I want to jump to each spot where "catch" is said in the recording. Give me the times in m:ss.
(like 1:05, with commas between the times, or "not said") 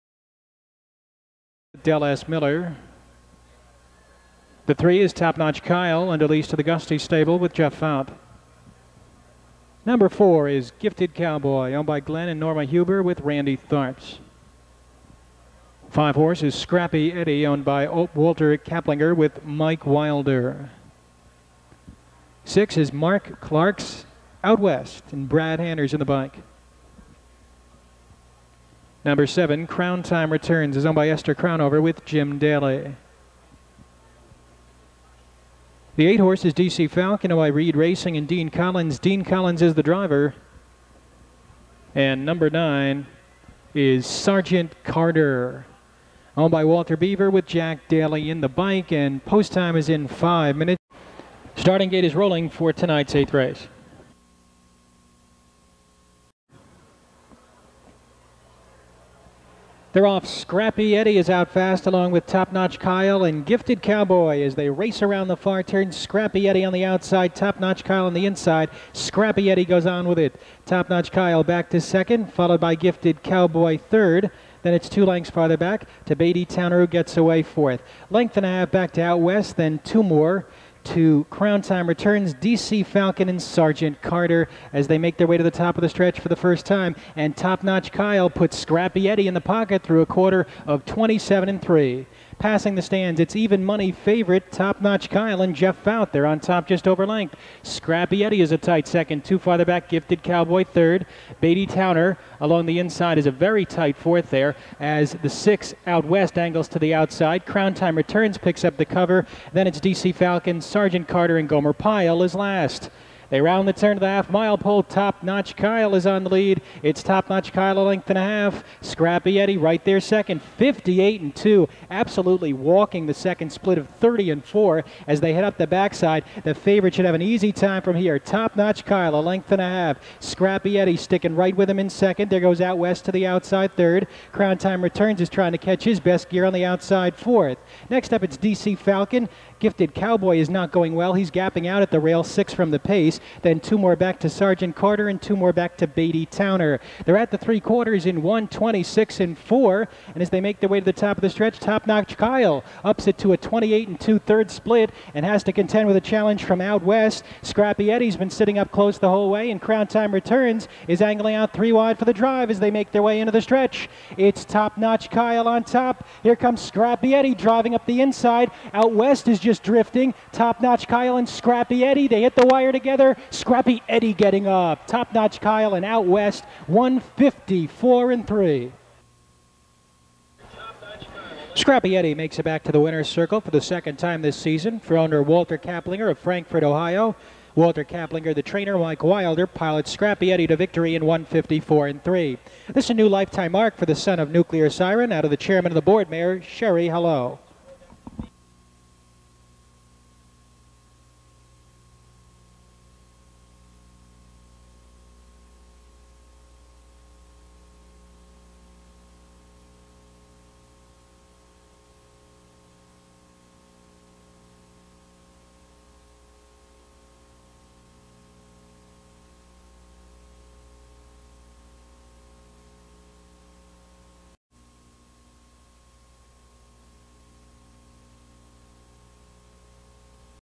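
2:15.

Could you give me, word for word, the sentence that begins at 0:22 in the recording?
Six is Mark Clark's Out West and Brad Hanners in the bike.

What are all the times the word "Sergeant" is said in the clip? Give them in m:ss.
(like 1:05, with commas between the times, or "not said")
0:44, 1:23, 1:50, 2:24.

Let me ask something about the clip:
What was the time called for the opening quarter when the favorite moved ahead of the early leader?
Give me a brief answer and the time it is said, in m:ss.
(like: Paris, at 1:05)
27 and 3, at 1:30.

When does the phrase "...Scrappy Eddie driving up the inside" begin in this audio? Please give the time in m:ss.
2:46.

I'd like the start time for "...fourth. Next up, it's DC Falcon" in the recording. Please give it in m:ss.
2:17.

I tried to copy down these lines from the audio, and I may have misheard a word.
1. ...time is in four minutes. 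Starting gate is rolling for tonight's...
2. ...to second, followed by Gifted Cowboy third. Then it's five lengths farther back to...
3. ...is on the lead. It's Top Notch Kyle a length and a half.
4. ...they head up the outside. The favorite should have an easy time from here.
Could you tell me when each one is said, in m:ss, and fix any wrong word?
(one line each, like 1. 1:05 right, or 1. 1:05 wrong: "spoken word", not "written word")
1. 0:49 wrong: "five", not "four"
2. 1:11 wrong: "two", not "five"
3. 1:55 right
4. 2:05 wrong: "backside", not "outside".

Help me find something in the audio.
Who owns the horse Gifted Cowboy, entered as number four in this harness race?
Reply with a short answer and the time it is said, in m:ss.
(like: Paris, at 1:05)
Glenn and Norma Huber, at 0:12.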